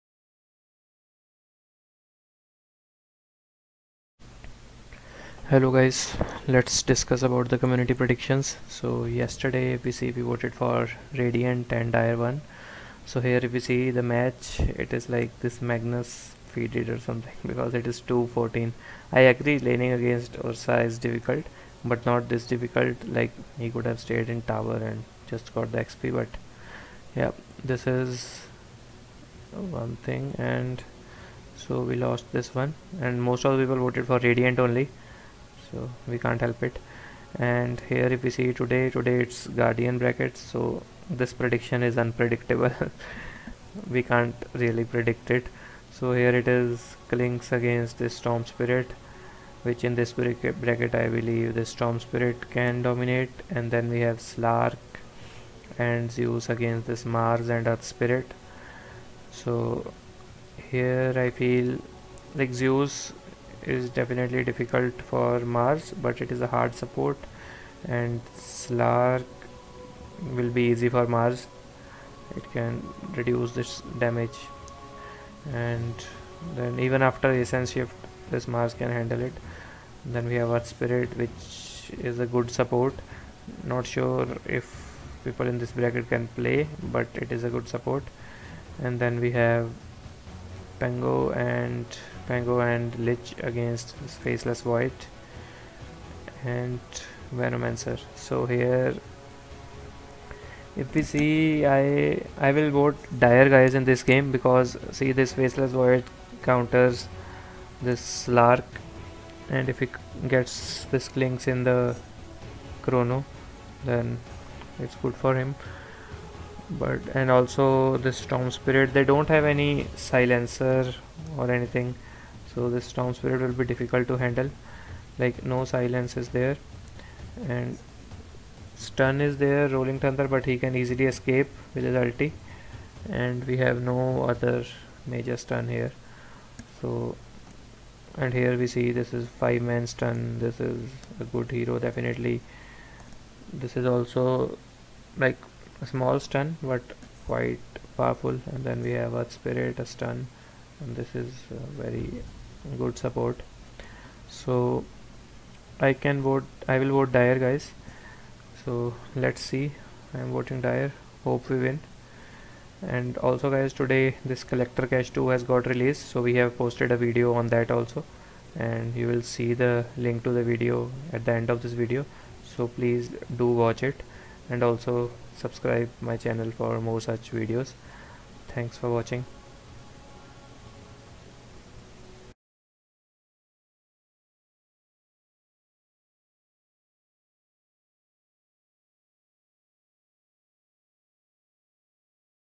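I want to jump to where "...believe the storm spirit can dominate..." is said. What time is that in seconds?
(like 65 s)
51 s.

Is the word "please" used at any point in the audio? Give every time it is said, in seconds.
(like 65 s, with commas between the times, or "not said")
172 s.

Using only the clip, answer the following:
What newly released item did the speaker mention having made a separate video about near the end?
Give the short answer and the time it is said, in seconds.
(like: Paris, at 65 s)
Collector's Cache 2, at 164 s.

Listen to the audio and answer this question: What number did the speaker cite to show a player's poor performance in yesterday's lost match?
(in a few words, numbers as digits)
214.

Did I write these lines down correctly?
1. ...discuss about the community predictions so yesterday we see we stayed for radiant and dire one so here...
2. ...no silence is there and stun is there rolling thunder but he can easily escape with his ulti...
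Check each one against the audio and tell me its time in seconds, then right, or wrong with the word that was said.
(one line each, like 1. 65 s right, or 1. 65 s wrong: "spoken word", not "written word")
1. 6 s wrong: "voted", not "stayed"
2. 125 s right.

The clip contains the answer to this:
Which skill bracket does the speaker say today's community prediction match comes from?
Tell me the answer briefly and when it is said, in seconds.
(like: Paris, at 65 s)
Guardian, at 39 s.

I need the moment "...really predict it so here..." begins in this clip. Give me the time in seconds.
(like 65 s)
44 s.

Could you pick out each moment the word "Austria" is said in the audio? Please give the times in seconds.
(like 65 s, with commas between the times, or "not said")
not said.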